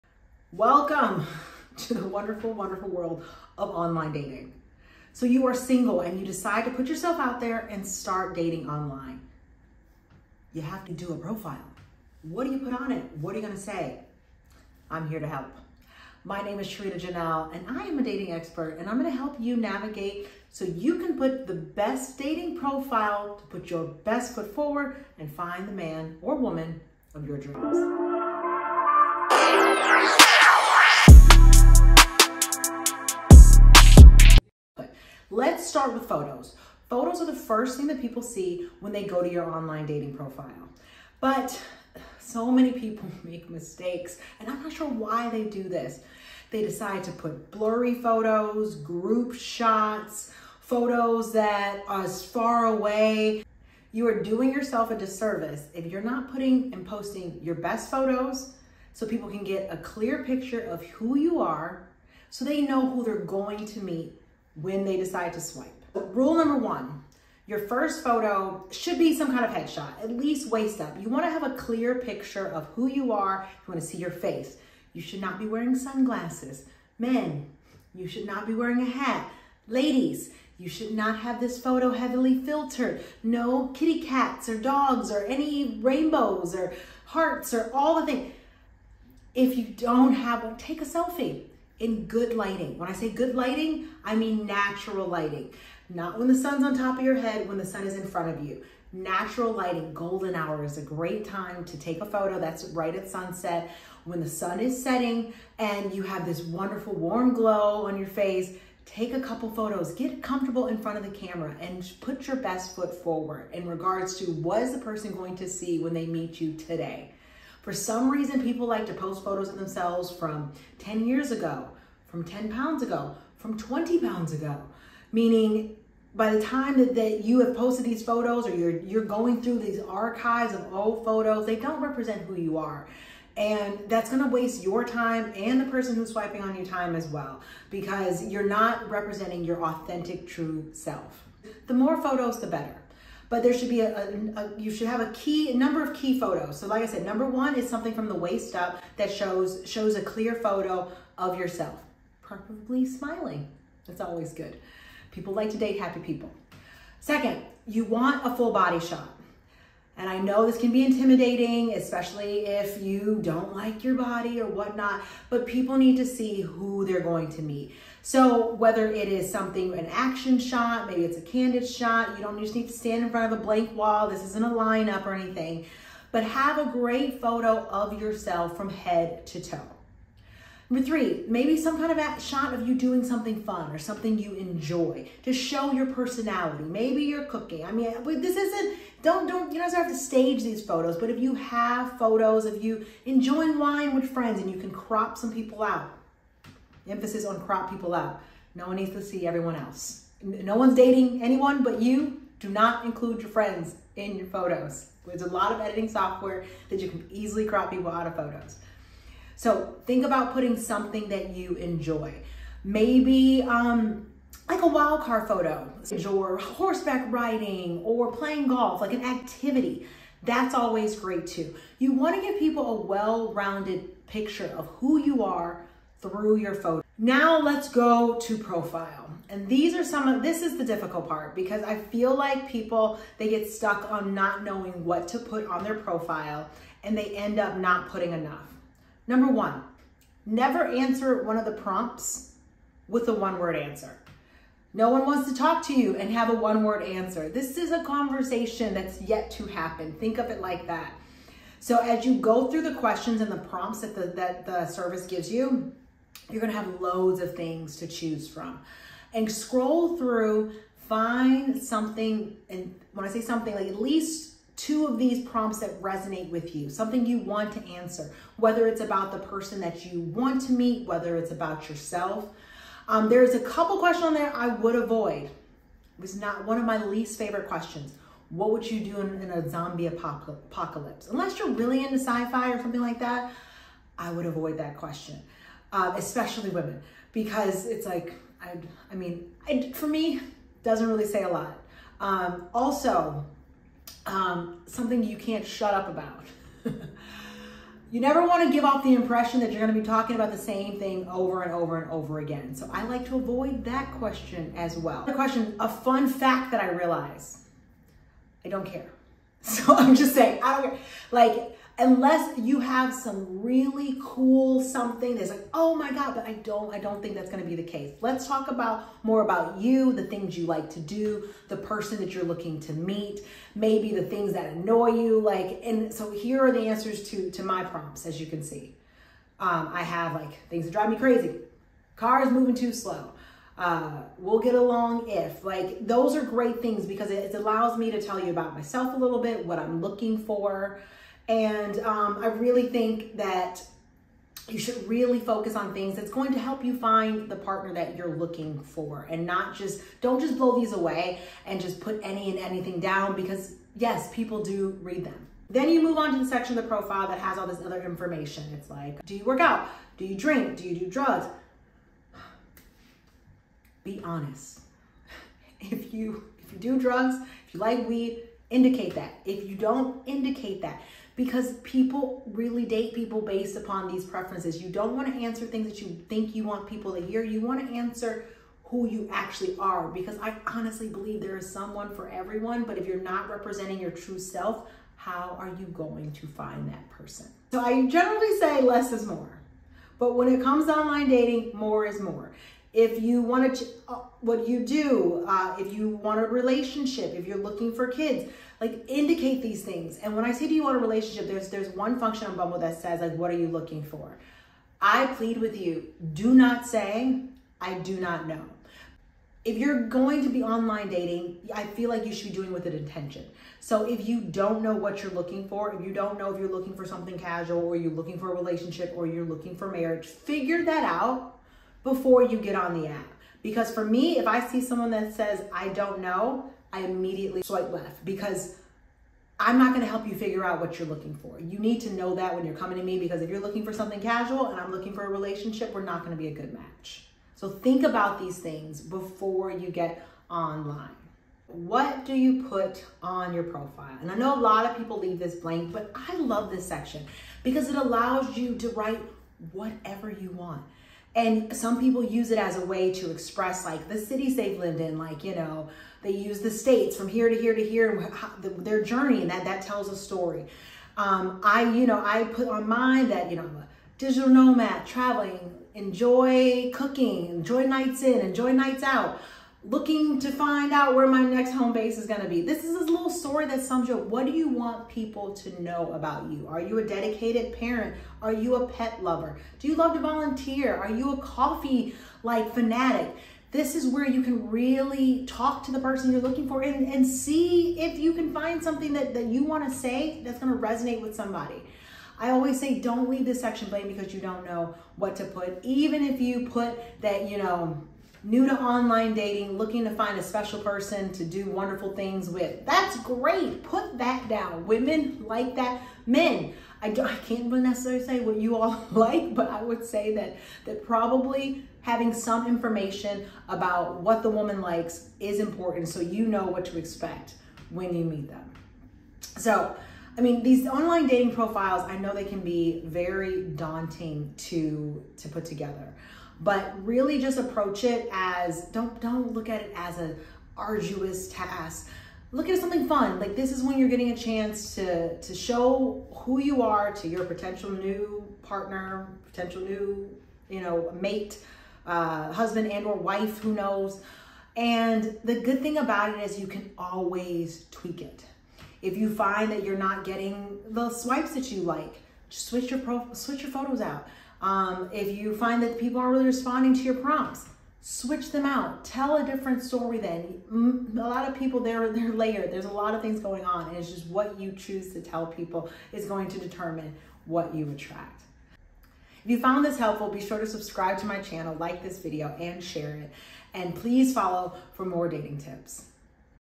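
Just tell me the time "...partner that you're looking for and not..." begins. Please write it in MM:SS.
05:47.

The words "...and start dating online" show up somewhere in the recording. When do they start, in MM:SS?
00:07.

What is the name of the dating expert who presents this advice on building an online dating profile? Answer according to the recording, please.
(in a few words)
Sherita Janielle.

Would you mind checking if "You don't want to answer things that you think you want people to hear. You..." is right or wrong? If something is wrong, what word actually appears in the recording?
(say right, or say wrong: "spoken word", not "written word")
right.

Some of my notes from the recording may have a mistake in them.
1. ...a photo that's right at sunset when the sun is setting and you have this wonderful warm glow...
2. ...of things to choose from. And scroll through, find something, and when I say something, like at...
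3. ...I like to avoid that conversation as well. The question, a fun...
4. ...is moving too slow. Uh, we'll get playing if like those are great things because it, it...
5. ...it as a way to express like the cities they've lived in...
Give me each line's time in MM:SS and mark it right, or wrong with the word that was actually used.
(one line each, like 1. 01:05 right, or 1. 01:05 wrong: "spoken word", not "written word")
1. 01:42 right
2. 04:17 right
3. 05:02 wrong: "question", not "conversation"
4. 05:32 wrong: "along", not "playing"
5. 07:32 right.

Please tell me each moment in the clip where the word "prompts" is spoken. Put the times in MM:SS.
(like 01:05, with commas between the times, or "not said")
04:01, 04:13, 04:25, 05:27, 09:16.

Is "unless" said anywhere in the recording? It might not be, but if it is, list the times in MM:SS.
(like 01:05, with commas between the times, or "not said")
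04:41, 05:11.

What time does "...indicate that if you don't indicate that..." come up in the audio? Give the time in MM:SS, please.
06:08.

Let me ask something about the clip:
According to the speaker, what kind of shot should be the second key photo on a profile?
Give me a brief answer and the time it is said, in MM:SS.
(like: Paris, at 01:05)
Full body shot, at 02:38.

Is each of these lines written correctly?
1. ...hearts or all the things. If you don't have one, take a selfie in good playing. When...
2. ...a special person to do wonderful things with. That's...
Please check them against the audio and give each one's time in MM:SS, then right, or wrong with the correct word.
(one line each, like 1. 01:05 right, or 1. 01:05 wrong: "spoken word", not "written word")
1. 01:27 wrong: "lighting", not "playing"
2. 08:20 right.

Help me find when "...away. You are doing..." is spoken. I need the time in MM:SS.
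00:52.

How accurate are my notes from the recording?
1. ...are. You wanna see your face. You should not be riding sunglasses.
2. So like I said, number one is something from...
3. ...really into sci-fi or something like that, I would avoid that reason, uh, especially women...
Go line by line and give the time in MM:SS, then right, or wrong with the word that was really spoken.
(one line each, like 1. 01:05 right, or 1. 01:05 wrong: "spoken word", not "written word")
1. 01:13 wrong: "wearing", not "riding"
2. 02:26 right
3. 04:41 wrong: "question", not "reason".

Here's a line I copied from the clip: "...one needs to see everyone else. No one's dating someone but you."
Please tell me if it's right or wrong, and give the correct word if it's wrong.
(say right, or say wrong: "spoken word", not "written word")
wrong: "anyone", not "someone".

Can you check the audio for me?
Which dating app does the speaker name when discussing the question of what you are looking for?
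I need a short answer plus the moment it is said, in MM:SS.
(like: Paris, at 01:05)
Bumble, at 06:42.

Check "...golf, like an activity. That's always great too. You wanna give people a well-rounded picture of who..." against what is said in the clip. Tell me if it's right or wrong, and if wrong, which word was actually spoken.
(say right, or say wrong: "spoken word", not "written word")
right.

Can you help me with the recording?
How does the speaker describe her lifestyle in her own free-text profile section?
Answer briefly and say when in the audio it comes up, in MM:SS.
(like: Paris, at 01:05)
Digital nomad, at 07:43.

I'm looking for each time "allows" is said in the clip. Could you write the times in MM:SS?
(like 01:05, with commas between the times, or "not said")
05:37, 07:27.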